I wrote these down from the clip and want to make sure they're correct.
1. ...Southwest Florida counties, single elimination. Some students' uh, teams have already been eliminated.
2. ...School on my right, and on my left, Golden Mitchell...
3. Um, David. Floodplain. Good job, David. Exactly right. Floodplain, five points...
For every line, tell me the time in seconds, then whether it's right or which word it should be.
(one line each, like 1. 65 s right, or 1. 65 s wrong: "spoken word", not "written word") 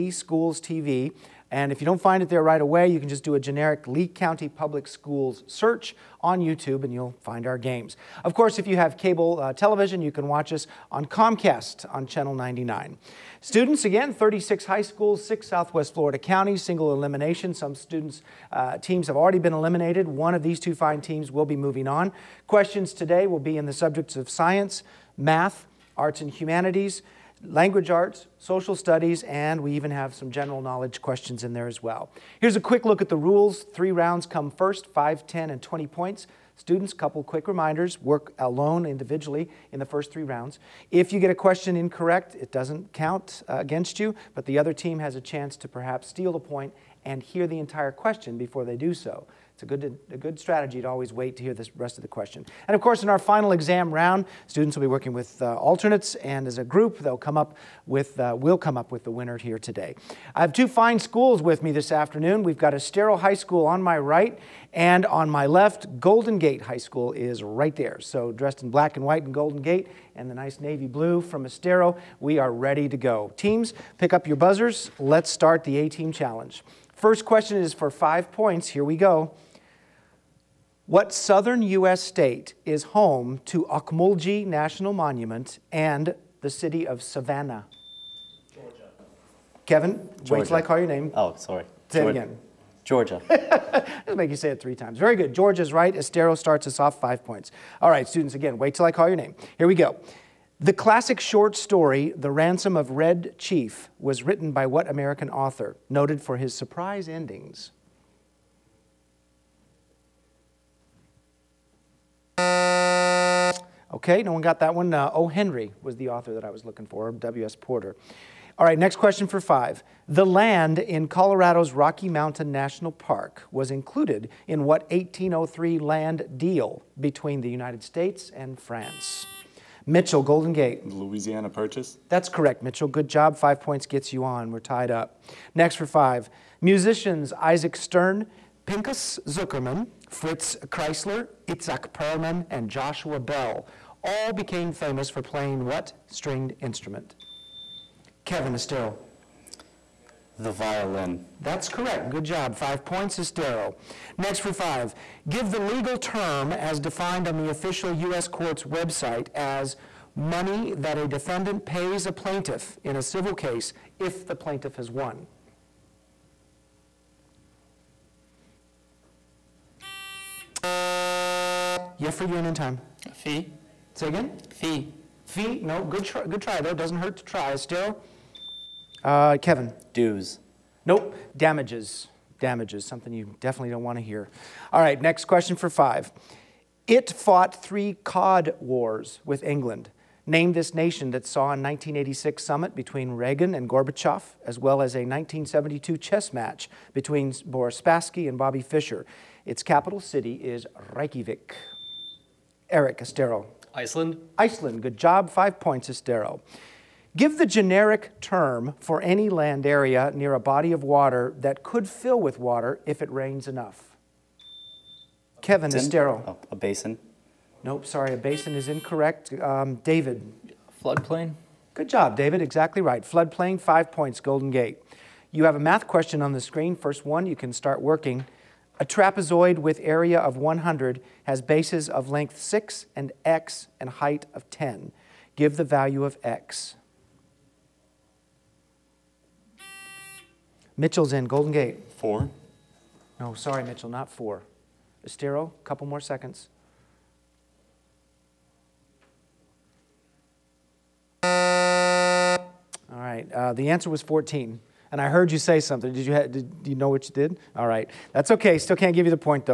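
1. 15 s right
2. 63 s wrong: "Gate", not "Mitchell"
3. 219 s right.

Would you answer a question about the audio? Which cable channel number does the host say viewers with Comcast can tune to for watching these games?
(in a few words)
99.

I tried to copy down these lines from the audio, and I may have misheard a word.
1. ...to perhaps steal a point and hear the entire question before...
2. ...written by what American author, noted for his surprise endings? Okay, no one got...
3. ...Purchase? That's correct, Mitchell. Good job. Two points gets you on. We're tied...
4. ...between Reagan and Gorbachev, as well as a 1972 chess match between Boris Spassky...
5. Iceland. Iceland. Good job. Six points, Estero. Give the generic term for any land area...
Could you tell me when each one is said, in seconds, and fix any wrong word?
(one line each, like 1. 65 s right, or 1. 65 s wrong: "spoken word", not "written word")
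1. 45 s right
2. 104 s right
3. 131 s wrong: "Five", not "Two"
4. 192 s right
5. 203 s wrong: "Five", not "Six".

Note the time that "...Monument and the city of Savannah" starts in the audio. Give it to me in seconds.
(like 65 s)
84 s.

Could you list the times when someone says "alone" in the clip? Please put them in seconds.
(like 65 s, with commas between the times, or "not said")
38 s.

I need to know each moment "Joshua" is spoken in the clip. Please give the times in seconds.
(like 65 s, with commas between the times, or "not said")
142 s.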